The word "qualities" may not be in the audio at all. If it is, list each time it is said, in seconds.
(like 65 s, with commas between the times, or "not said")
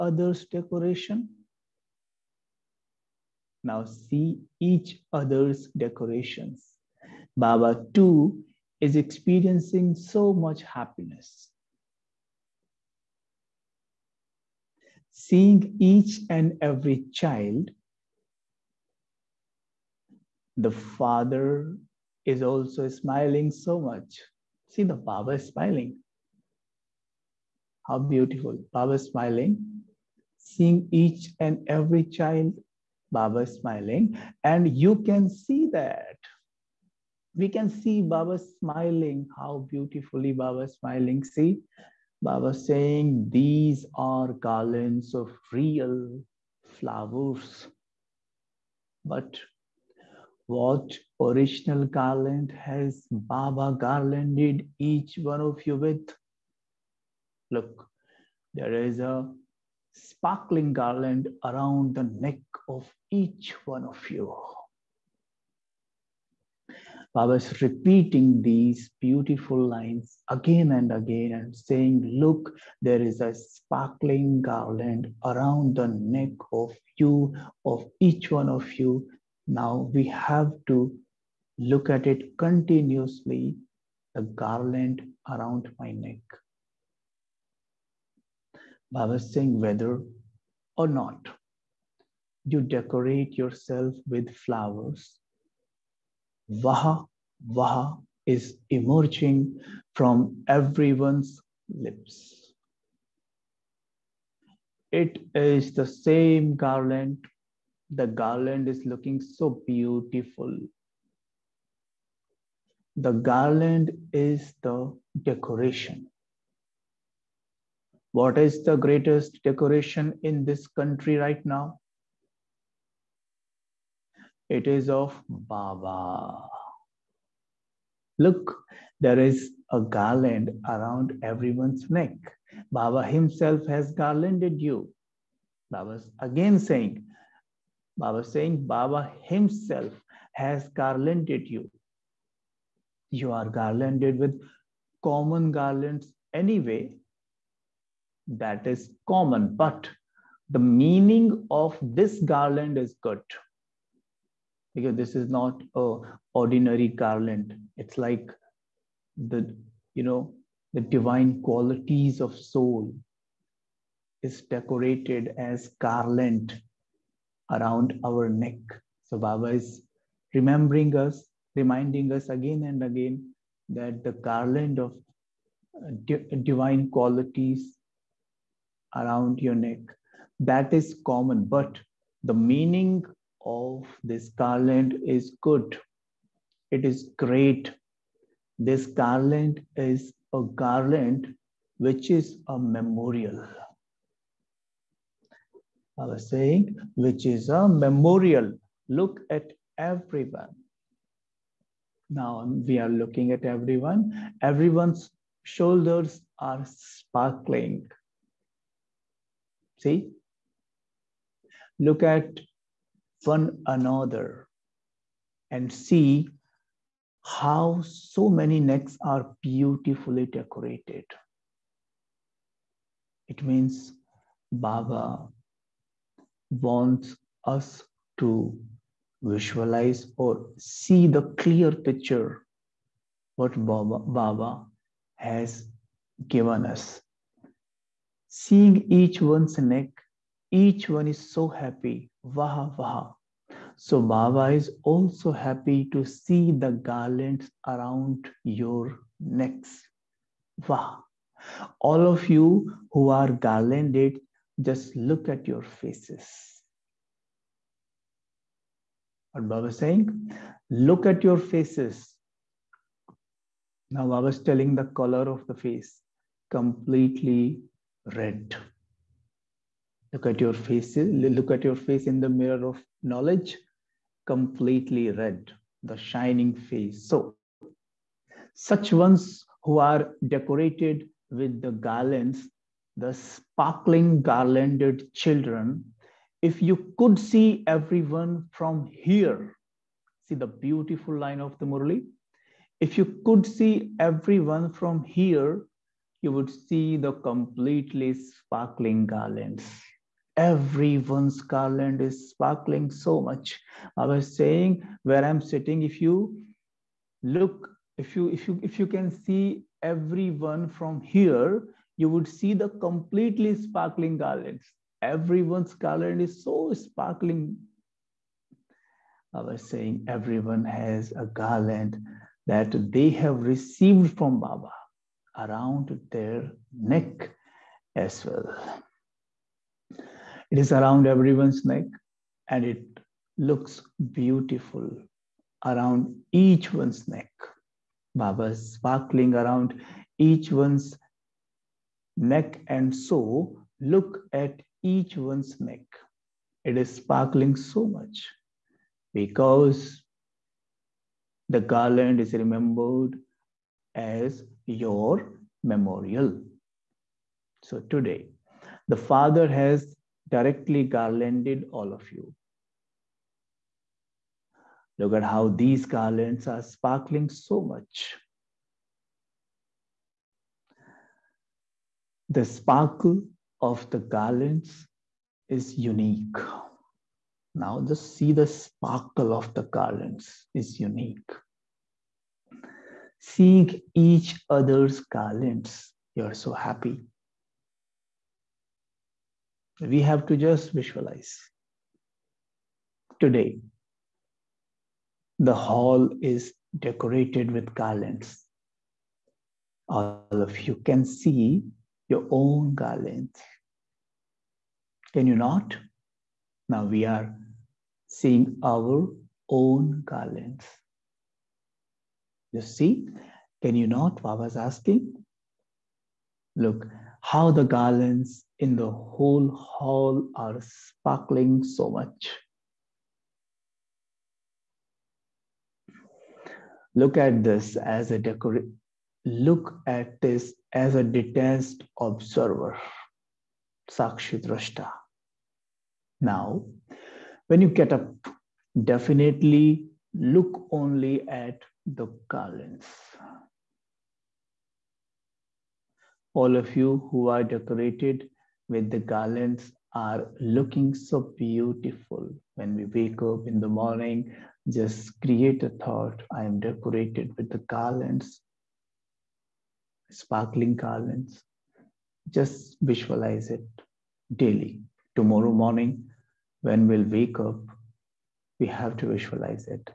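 161 s, 176 s.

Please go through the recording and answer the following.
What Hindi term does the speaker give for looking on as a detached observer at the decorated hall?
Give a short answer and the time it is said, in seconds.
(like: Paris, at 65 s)
Sakshidrashta, at 433 s.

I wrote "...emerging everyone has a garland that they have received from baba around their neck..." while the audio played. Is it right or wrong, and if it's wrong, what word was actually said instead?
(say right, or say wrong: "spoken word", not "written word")
wrong: "saying", not "emerging".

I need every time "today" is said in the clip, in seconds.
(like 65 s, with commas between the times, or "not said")
357 s, 393 s.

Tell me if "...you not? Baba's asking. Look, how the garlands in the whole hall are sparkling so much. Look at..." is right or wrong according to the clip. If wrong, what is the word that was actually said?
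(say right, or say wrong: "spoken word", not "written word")
right.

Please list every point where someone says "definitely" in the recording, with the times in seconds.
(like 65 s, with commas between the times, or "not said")
438 s.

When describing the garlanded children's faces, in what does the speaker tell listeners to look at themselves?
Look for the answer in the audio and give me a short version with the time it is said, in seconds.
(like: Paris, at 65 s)
mirror of knowledge, at 272 s.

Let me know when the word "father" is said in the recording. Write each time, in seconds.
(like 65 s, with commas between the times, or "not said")
20 s, 358 s.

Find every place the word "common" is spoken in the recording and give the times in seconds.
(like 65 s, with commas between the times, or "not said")
145 s, 149 s, 181 s.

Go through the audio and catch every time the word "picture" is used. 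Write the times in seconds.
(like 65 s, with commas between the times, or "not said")
231 s.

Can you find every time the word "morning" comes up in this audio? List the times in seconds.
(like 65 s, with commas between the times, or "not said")
453 s, 465 s.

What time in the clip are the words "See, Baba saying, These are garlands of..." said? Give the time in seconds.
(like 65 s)
41 s.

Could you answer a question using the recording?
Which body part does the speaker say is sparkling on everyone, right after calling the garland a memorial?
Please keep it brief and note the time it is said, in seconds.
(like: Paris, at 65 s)
shoulders, at 205 s.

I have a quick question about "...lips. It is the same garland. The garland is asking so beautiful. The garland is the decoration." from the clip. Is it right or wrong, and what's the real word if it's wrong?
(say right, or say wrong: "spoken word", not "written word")
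wrong: "looking", not "asking".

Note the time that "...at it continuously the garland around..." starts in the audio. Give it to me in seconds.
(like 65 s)
81 s.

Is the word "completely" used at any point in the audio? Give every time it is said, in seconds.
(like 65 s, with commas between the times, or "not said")
266 s, 274 s, 297 s, 312 s.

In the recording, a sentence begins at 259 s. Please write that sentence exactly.
What Baba is saying, look at your faces.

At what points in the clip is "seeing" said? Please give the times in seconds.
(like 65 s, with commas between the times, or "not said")
15 s, 30 s, 238 s, 383 s, 408 s.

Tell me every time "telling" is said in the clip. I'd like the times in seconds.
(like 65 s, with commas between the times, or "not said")
264 s.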